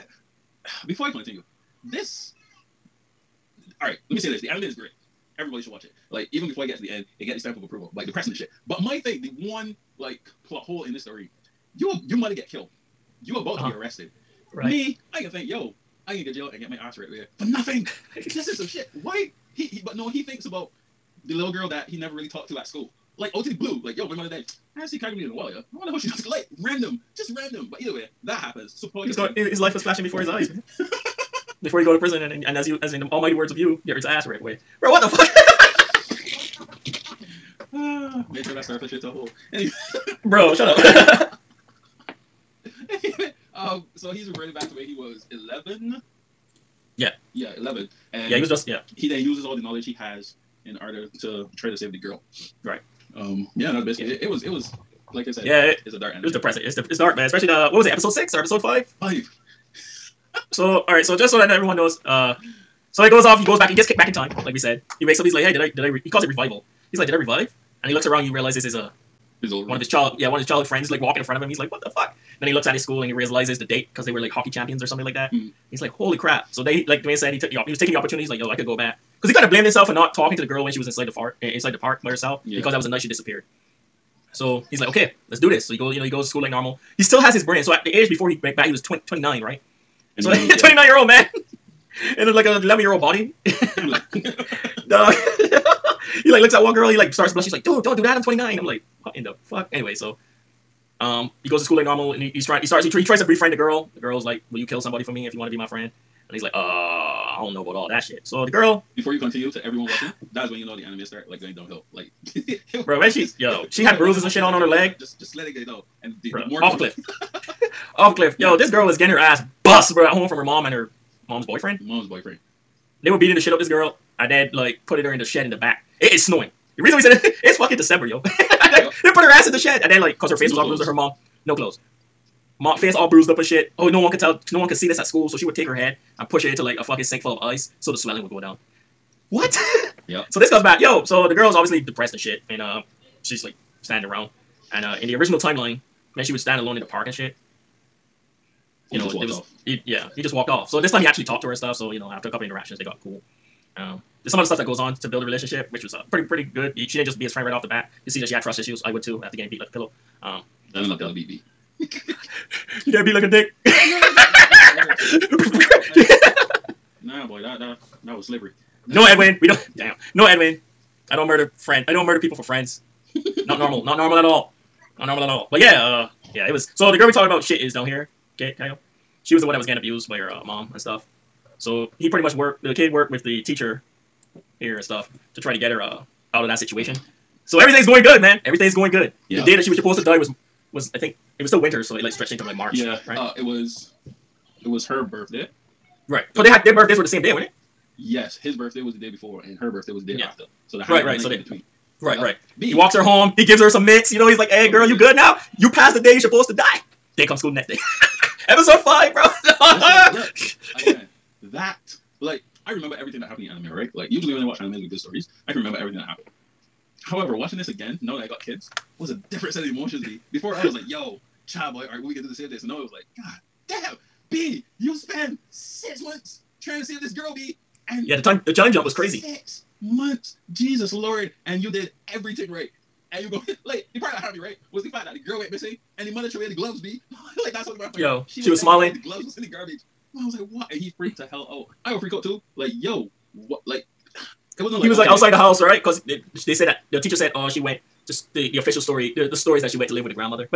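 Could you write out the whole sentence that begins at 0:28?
Support He's got his life was flashing before his eyes, man.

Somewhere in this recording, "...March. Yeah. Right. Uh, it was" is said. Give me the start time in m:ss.
3:12.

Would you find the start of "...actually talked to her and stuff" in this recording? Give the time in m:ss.
2:31.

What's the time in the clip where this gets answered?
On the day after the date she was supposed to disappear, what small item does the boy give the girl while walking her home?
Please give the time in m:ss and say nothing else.
3:23.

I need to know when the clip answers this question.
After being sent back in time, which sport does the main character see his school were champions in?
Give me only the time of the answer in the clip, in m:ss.
1:14.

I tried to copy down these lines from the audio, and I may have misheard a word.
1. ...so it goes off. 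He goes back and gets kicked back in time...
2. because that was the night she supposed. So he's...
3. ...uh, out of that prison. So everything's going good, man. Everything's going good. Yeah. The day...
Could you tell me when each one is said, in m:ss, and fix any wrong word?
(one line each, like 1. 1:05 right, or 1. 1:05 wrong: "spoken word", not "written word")
1. 1:02 right
2. 1:22 wrong: "disappeared", not "supposed"
3. 3:05 wrong: "situation", not "prison".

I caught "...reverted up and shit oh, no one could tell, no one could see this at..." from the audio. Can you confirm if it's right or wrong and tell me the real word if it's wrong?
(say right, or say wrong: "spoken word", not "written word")
wrong: "bruised", not "reverted".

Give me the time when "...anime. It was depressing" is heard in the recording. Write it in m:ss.
0:56.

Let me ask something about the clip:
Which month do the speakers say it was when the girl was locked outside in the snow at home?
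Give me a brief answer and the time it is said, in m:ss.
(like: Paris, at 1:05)
December, at 2:07.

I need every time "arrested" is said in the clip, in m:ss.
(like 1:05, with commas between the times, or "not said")
0:13.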